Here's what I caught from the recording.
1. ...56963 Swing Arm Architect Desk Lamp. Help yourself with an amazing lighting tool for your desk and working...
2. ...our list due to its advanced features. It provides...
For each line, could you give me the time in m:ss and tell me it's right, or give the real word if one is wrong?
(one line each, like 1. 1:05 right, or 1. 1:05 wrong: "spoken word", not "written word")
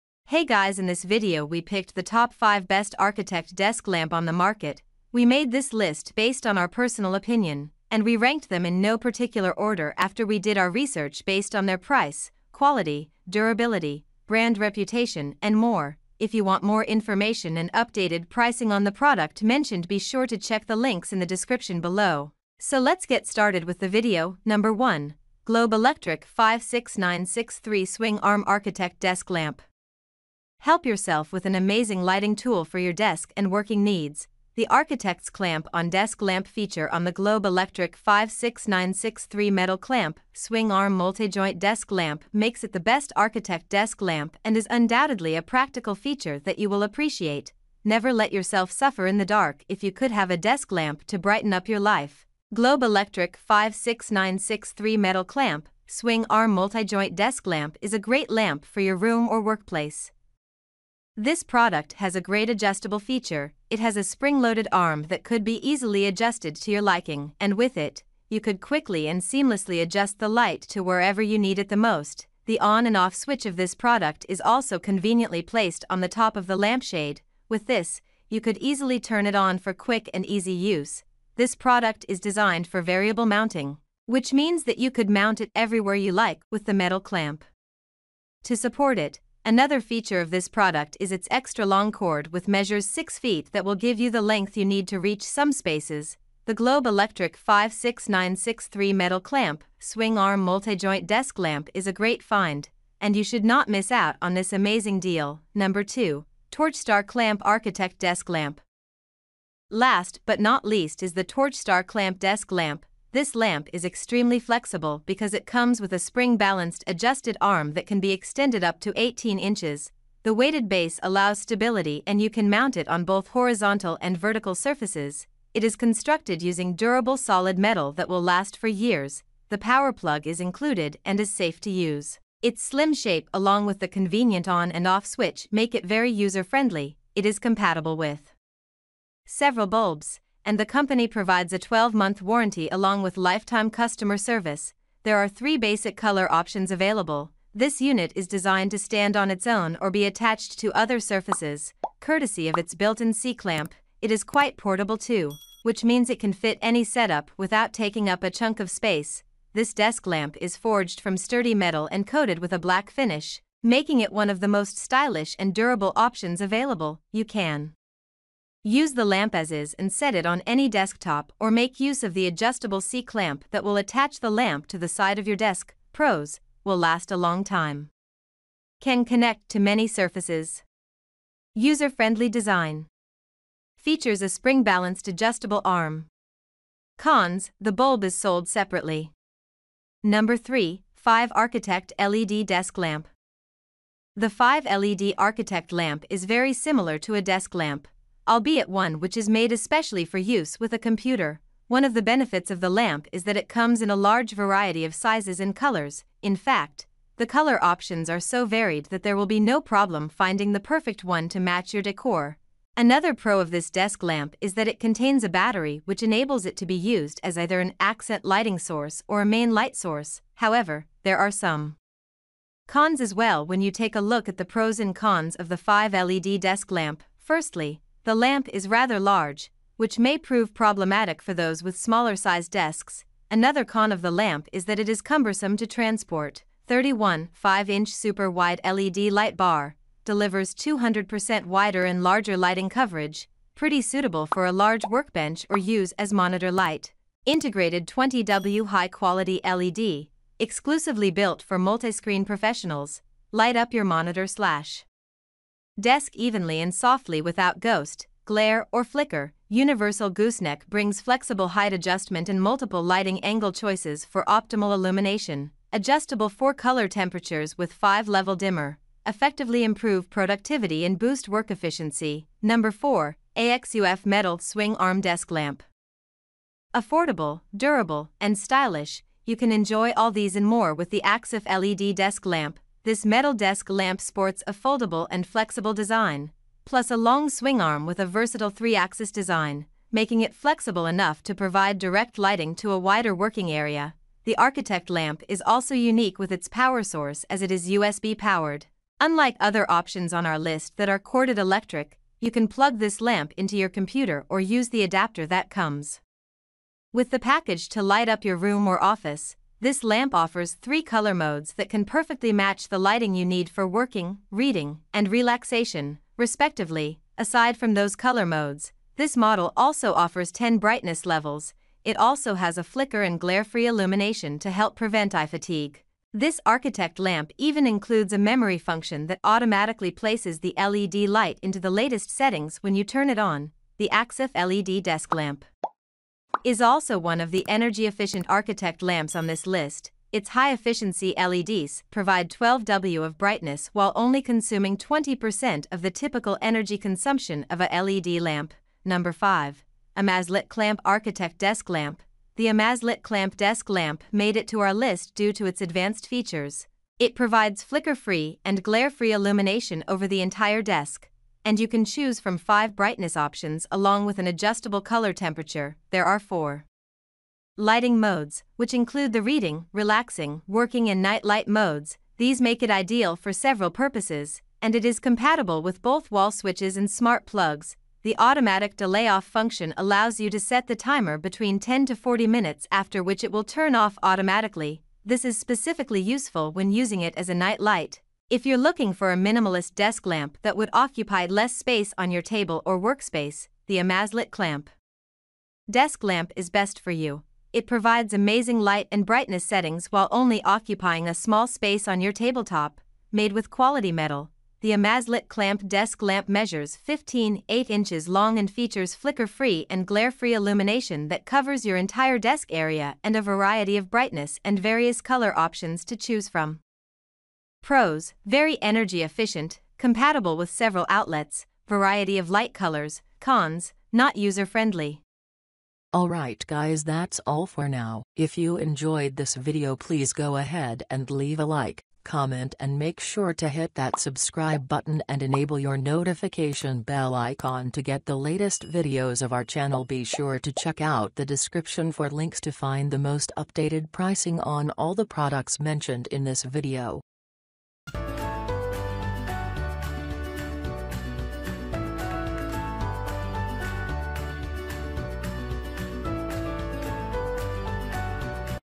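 1. 0:26 right
2. 5:54 right.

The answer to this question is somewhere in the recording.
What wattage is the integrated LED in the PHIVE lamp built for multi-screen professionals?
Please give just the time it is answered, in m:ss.
4:07.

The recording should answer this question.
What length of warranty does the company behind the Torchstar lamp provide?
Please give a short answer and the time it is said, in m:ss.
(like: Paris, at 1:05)
12 months, at 2:21.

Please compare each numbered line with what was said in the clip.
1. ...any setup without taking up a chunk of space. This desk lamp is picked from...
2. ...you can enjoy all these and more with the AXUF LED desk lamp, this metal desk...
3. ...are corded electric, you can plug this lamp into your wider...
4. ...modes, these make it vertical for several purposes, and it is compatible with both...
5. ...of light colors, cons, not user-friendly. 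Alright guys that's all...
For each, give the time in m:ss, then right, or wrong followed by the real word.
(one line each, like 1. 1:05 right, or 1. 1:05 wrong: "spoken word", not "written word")
1. 2:36 wrong: "forged", not "picked"
2. 4:39 right
3. 5:00 wrong: "computer", not "wider"
4. 6:11 wrong: "ideal", not "vertical"
5. 7:02 right.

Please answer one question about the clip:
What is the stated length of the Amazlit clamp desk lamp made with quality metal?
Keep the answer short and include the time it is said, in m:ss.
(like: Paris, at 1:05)
15.8 inches, at 6:46.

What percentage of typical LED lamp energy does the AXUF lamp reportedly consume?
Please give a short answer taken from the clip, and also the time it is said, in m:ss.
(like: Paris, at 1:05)
20%, at 5:44.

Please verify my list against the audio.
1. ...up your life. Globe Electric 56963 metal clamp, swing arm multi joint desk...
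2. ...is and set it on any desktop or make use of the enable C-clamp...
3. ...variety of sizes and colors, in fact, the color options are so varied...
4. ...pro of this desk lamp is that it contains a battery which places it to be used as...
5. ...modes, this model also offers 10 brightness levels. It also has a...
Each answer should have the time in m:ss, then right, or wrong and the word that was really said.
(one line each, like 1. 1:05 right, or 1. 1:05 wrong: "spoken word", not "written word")
1. 0:51 right
2. 2:49 wrong: "adjustable", not "enable"
3. 3:24 right
4. 3:33 wrong: "enables", not "places"
5. 5:18 right.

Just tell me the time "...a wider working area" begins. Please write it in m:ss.
4:52.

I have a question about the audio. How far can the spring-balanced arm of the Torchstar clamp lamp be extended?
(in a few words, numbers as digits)
18 inches.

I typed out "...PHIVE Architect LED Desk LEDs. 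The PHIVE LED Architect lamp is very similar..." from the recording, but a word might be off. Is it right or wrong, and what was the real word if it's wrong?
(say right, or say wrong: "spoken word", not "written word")
wrong: "Lamp", not "LEDs".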